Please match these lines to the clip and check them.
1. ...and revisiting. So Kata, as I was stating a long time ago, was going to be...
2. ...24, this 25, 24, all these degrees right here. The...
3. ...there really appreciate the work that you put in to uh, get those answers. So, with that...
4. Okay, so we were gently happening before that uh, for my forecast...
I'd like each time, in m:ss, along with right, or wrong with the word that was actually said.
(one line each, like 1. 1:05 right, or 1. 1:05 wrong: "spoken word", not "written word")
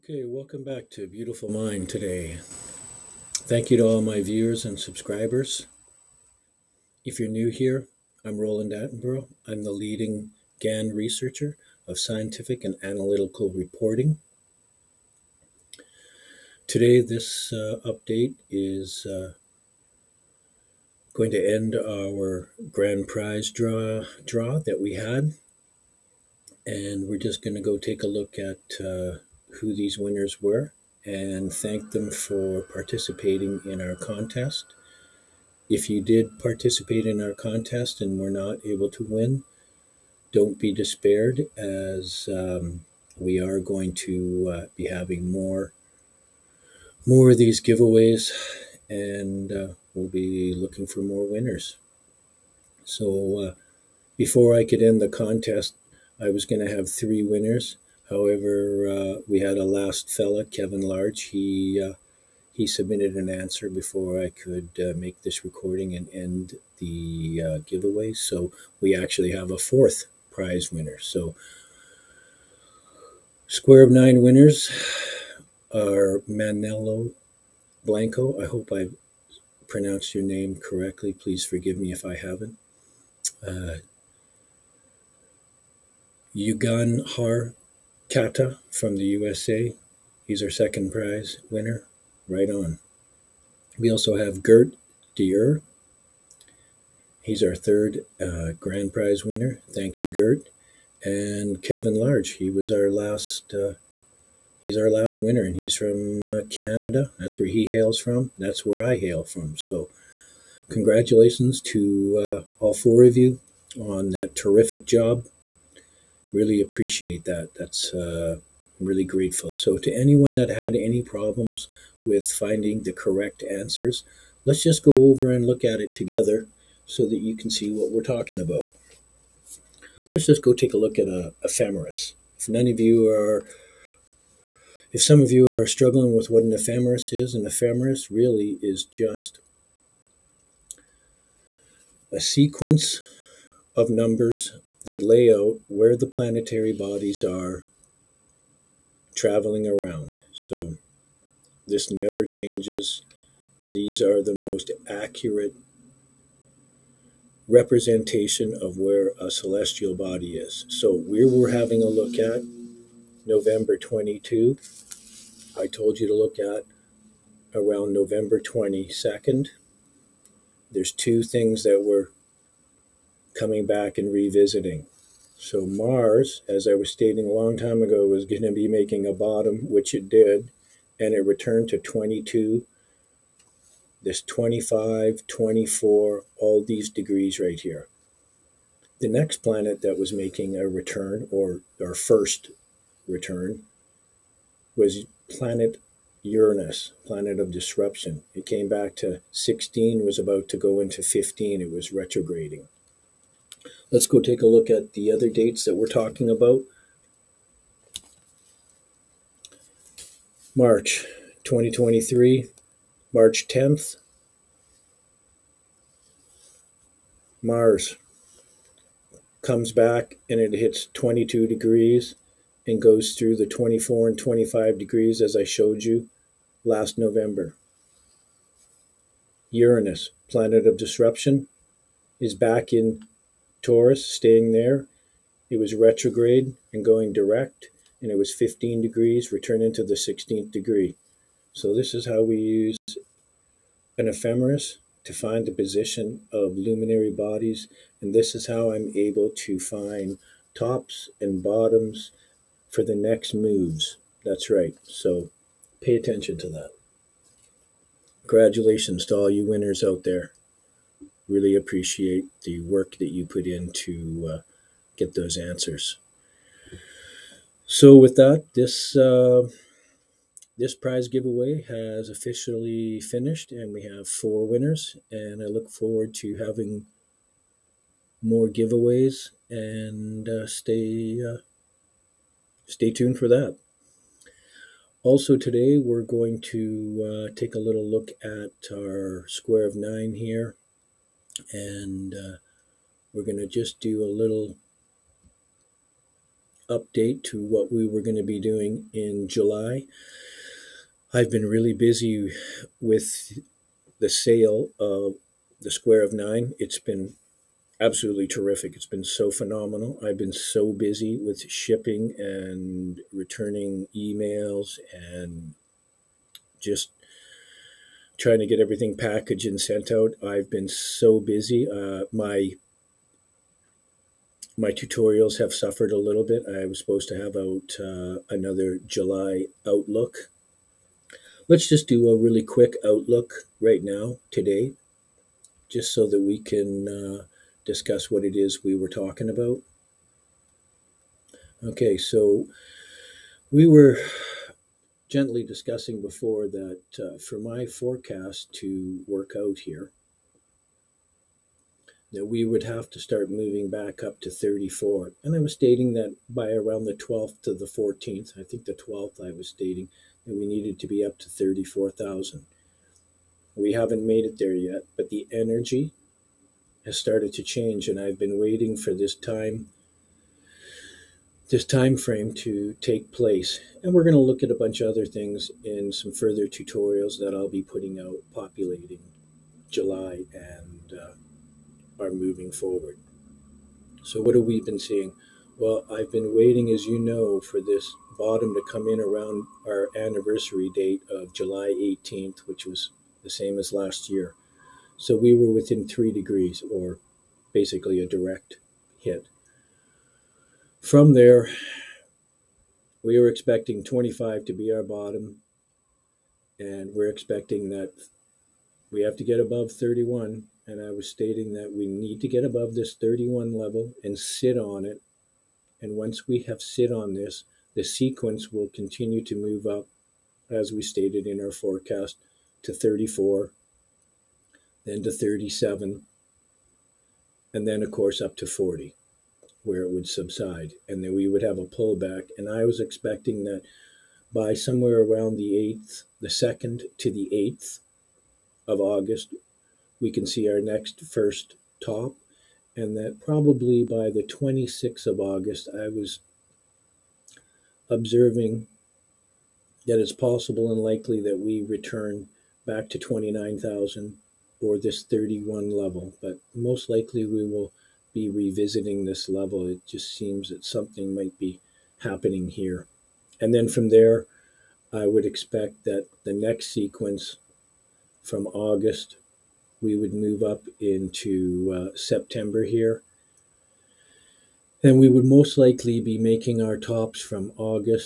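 1. 2:53 wrong: "Mars", not "Kata"
2. 3:01 wrong: "22", not "24"
3. 4:20 right
4. 5:41 wrong: "discussing", not "happening".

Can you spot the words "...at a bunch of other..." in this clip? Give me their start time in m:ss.
6:14.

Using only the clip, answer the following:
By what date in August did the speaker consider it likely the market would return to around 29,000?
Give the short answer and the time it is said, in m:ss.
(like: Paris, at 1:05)
August 26th, at 7:24.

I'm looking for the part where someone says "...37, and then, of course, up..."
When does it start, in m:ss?
7:05.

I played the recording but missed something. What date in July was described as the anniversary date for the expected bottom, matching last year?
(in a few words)
July 18th.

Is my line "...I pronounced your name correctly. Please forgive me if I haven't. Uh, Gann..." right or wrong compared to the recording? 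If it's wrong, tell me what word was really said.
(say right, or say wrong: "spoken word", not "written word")
wrong: "Yugan", not "Gann".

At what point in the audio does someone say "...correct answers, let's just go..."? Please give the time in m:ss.
2:02.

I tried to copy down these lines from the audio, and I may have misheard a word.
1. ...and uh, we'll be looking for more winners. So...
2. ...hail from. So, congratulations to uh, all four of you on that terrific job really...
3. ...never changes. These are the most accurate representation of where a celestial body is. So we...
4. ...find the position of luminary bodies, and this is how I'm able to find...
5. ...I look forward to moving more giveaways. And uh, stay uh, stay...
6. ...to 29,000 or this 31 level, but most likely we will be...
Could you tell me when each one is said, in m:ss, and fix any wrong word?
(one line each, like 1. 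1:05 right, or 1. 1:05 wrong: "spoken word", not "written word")
1. 0:48 right
2. 1:48 right
3. 2:31 right
4. 4:05 right
5. 4:35 wrong: "having", not "moving"
6. 7:32 right.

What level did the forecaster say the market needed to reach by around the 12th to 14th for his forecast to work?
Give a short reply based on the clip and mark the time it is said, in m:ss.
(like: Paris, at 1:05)
34,000, at 6:01.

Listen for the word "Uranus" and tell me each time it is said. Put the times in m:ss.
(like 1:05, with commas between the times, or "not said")
3:16, 3:49.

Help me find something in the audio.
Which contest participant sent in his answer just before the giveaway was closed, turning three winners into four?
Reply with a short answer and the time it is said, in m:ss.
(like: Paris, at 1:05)
Kevin Larch, at 1:00.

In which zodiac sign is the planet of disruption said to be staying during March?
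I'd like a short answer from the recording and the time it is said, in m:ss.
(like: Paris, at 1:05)
Taurus, at 3:53.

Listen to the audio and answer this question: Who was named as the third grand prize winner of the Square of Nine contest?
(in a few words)
Gert Dier.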